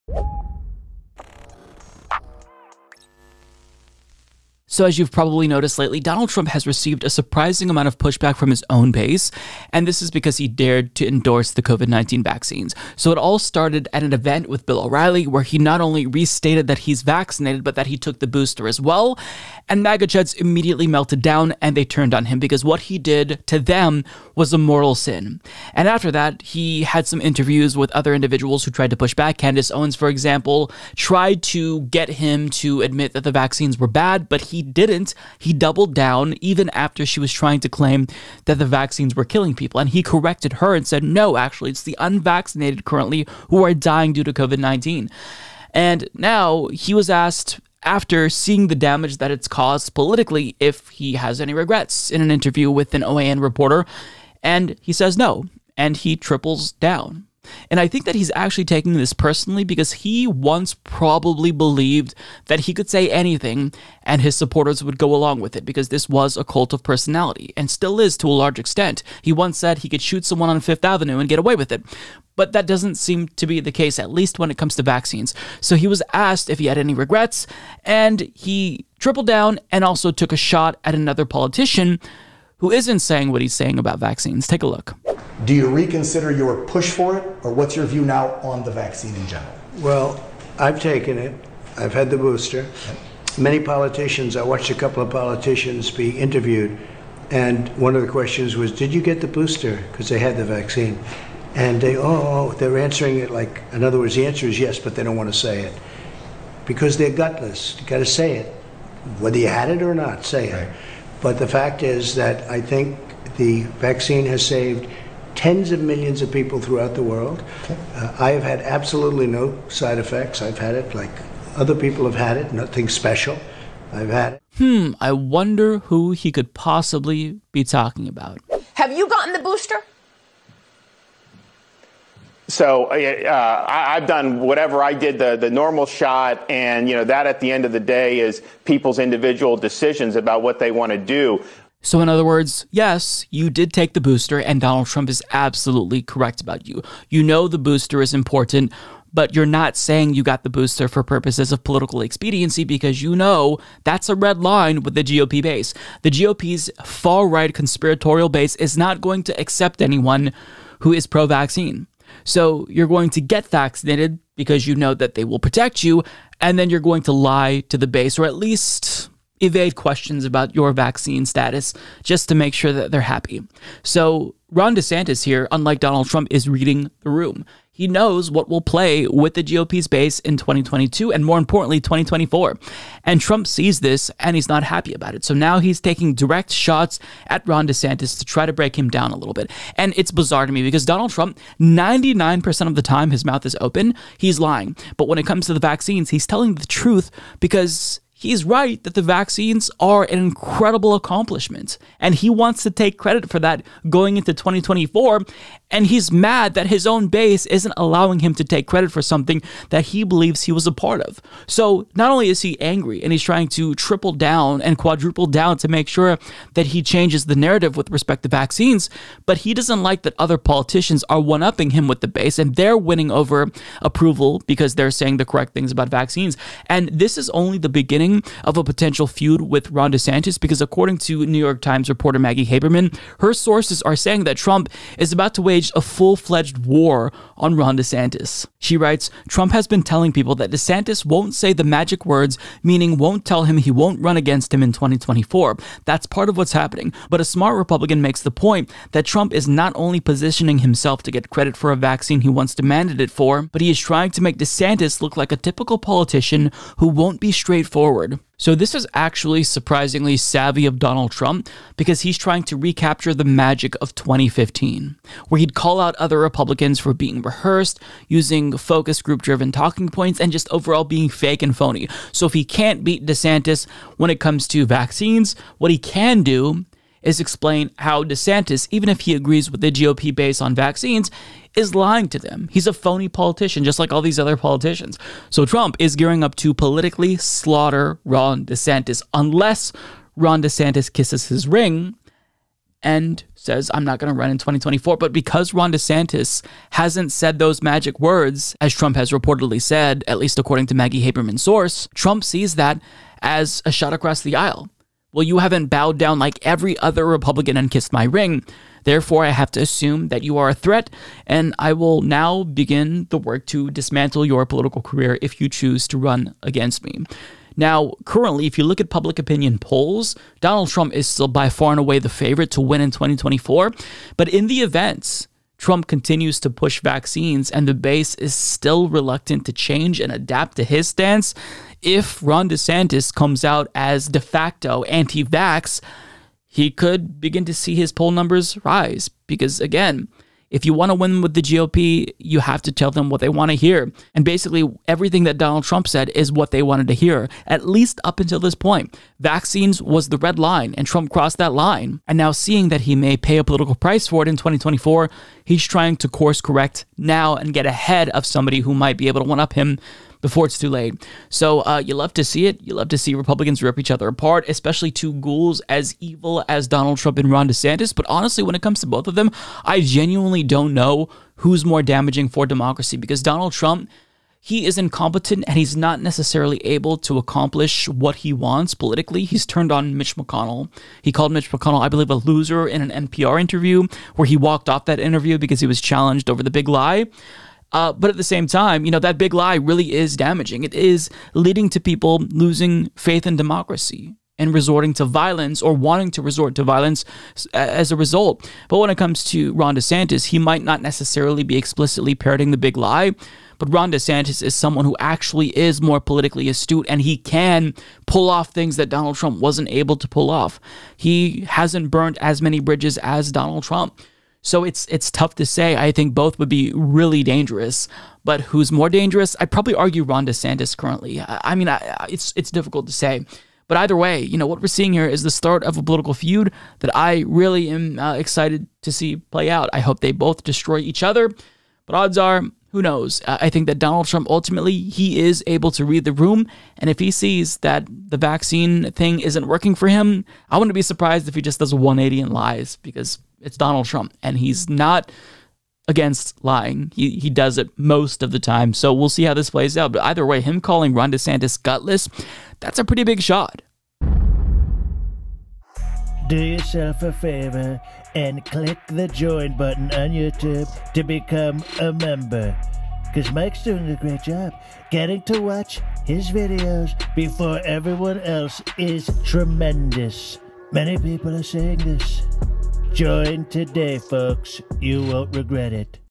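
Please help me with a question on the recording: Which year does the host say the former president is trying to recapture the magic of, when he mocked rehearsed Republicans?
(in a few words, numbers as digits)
2015.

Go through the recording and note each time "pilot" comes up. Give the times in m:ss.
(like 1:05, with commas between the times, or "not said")
not said.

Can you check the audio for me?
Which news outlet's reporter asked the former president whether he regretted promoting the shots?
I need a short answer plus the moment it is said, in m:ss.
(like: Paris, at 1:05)
OAN, at 0:53.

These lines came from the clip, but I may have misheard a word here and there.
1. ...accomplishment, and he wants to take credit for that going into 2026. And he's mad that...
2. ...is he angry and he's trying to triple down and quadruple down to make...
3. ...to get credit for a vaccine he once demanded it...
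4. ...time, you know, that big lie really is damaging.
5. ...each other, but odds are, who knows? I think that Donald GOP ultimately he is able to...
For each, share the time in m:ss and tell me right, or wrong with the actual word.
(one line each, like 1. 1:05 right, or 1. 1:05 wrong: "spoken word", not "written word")
1. 3:20 wrong: "2024", not "2026"
2. 3:32 right
3. 4:11 right
4. 6:28 right
5. 7:10 wrong: "Trump", not "GOP".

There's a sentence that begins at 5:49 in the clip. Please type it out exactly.
Vaccines was the red line, and Trump crossed that line.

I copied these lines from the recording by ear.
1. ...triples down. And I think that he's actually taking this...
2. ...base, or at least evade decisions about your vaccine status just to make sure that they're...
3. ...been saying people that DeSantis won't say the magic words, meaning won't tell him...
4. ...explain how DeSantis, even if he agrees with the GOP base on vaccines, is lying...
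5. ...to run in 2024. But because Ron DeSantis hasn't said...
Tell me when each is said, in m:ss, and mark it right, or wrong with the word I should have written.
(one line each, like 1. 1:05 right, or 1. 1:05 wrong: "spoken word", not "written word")
1. 0:56 right
2. 2:47 wrong: "questions", not "decisions"
3. 3:59 wrong: "telling", not "saying"
4. 4:37 right
5. 4:54 right.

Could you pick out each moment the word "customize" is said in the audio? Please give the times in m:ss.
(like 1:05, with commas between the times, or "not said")
not said.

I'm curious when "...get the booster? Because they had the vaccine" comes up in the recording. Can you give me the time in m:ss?
1:39.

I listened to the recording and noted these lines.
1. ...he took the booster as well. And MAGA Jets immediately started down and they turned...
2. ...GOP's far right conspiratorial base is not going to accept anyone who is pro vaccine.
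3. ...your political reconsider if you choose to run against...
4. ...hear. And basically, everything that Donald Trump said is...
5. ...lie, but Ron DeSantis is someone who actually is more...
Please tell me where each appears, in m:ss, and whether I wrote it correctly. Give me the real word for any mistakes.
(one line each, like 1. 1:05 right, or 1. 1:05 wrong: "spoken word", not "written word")
1. 0:17 wrong: "melted", not "started"
2. 2:36 right
3. 5:14 wrong: "career", not "reconsider"
4. 5:43 right
5. 6:42 right.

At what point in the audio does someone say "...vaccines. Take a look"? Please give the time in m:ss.
1:23.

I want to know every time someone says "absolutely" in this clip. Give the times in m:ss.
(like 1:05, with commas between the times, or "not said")
1:58, 2:25.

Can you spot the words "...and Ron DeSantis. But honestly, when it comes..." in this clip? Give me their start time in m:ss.
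6:07.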